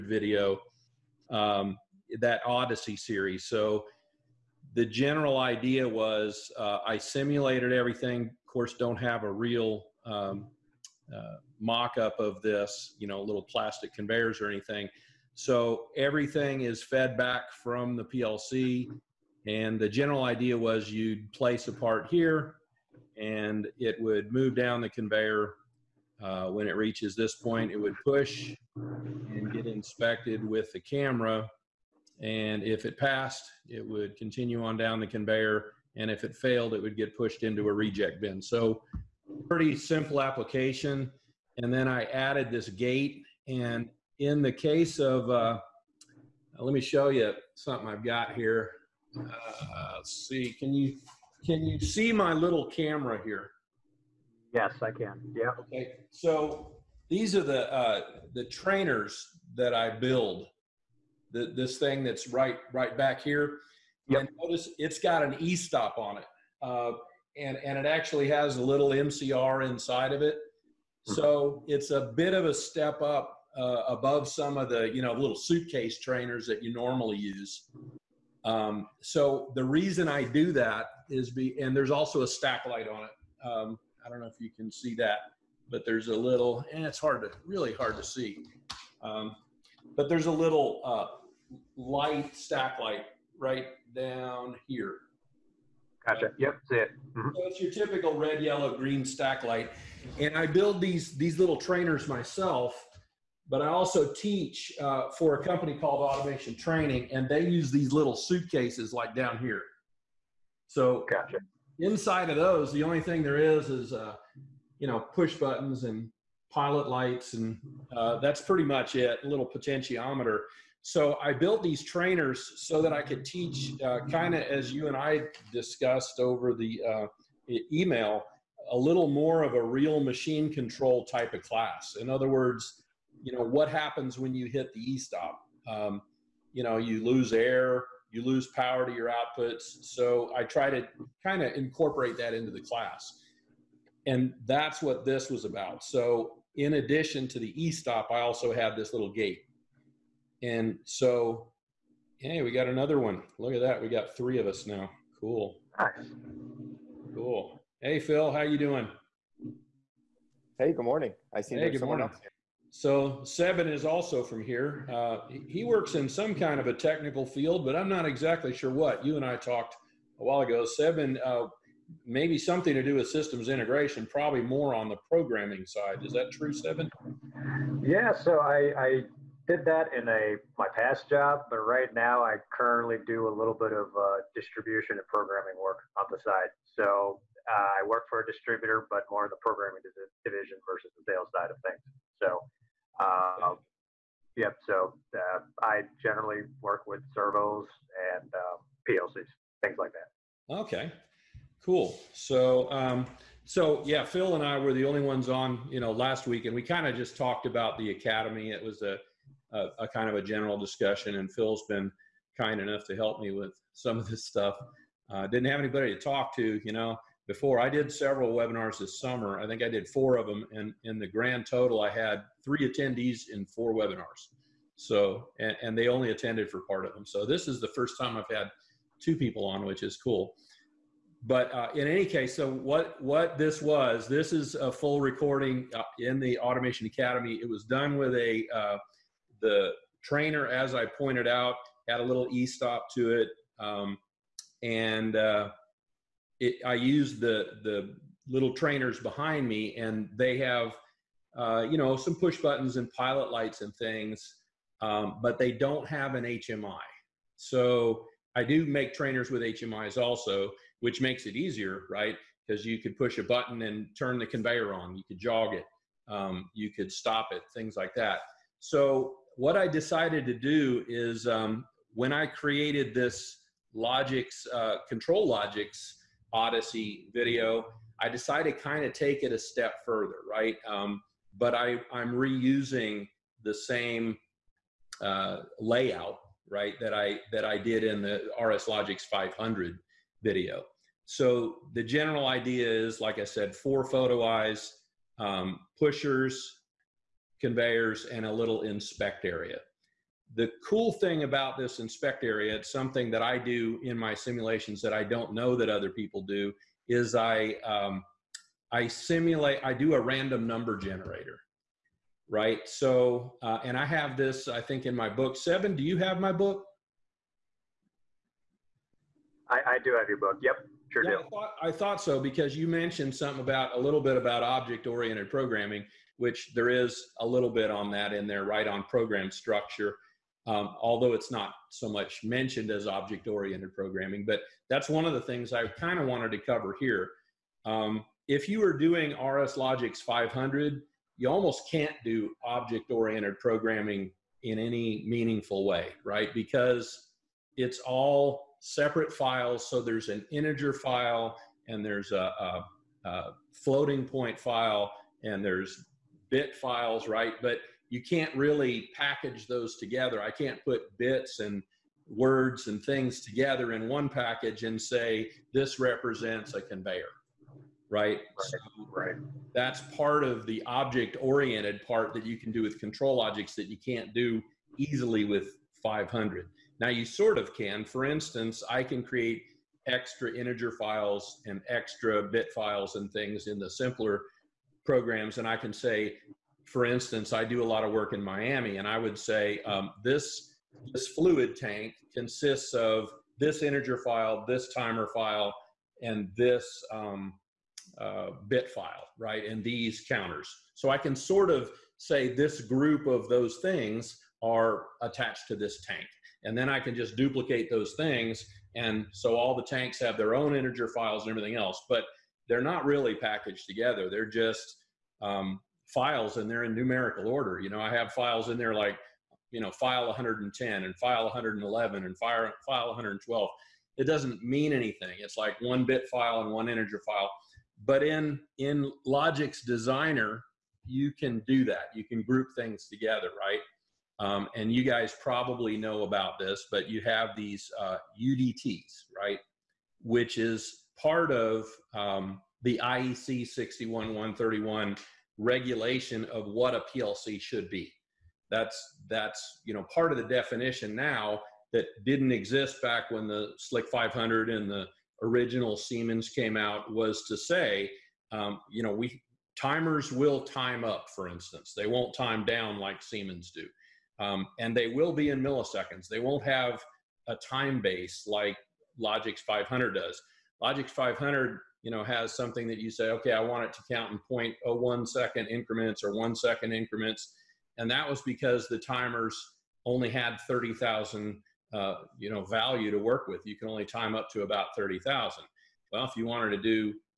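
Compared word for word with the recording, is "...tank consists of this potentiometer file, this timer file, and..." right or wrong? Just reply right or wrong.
wrong.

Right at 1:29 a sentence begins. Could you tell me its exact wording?
Um, but there's a little uh, light stack light right down here.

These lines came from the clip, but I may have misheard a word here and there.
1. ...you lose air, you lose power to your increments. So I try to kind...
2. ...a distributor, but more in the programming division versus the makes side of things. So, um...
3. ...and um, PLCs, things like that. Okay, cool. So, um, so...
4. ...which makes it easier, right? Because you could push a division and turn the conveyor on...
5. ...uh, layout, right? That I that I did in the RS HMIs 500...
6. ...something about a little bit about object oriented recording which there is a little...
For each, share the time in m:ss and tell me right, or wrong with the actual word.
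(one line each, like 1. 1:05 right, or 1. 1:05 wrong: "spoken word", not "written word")
1. 2:16 wrong: "outputs", not "increments"
2. 3:08 wrong: "sales", not "makes"
3. 3:18 right
4. 4:20 wrong: "button", not "division"
5. 4:45 wrong: "Logix", not "HMIs"
6. 5:23 wrong: "programming", not "recording".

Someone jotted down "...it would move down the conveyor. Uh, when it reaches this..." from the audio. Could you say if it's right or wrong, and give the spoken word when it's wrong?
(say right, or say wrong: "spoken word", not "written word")
right.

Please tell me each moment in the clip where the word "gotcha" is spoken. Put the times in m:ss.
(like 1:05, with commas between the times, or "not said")
1:36, 1:51.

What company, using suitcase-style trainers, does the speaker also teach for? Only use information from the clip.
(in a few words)
Automation Training.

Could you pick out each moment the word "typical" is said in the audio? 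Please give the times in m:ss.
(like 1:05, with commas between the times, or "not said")
1:37.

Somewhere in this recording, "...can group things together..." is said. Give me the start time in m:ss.
7:12.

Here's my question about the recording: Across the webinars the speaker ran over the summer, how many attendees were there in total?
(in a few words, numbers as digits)
3.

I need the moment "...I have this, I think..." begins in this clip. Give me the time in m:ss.
5:13.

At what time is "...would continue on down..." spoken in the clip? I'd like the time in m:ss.
0:33.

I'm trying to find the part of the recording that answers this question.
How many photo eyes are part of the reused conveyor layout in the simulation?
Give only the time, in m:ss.
4:53.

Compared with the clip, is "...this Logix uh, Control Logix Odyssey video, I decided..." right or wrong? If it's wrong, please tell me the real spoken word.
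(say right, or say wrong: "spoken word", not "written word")
right.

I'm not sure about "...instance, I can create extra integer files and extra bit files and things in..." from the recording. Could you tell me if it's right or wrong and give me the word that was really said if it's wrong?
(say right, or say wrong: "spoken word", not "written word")
right.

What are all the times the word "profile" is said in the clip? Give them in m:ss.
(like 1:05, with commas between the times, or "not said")
not said.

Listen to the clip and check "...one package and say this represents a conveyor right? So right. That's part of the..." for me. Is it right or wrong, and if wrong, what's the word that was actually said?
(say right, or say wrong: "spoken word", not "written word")
right.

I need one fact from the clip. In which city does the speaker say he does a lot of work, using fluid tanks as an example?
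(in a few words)
Miami.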